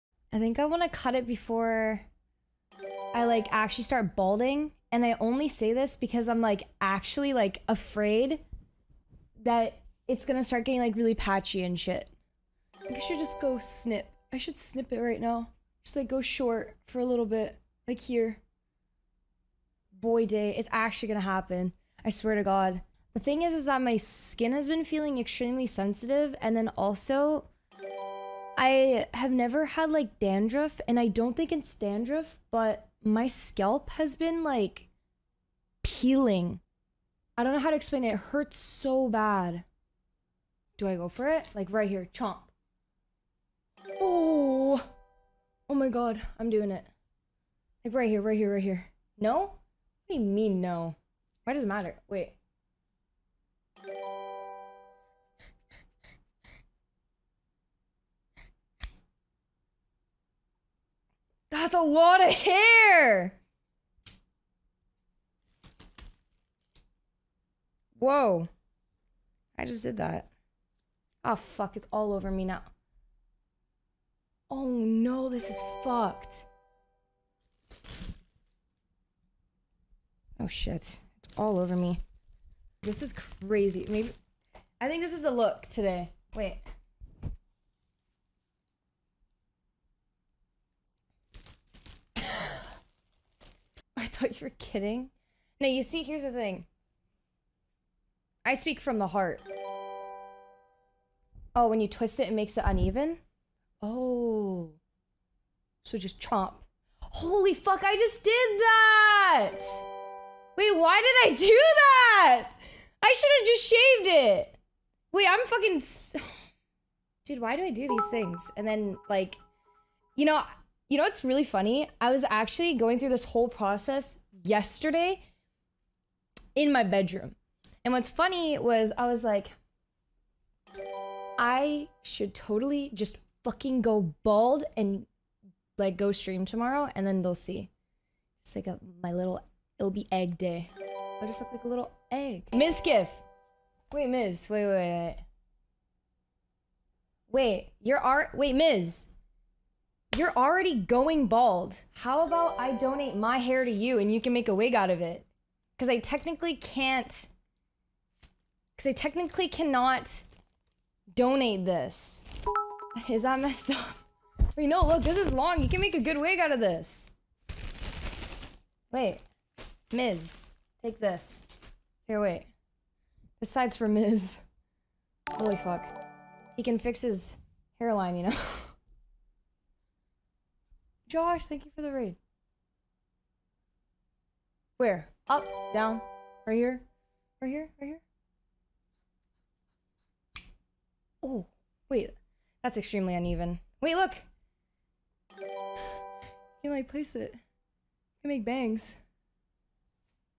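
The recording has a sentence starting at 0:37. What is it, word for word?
I don't know how to explain it.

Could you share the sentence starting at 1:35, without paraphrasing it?
No, you see, here's the thing.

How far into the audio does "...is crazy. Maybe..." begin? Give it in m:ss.
1:23.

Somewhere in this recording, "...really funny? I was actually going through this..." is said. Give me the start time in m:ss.
2:01.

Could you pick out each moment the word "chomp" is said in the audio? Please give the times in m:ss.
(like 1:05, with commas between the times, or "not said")
0:42, 1:46.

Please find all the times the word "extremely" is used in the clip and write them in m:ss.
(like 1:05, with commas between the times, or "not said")
0:25, 3:12.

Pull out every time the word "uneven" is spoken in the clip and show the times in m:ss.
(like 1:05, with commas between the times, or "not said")
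1:42, 3:13.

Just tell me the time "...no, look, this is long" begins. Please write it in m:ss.
2:44.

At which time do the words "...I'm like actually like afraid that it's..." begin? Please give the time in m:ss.
0:06.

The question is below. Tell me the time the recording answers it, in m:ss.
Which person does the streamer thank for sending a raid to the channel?
3:01.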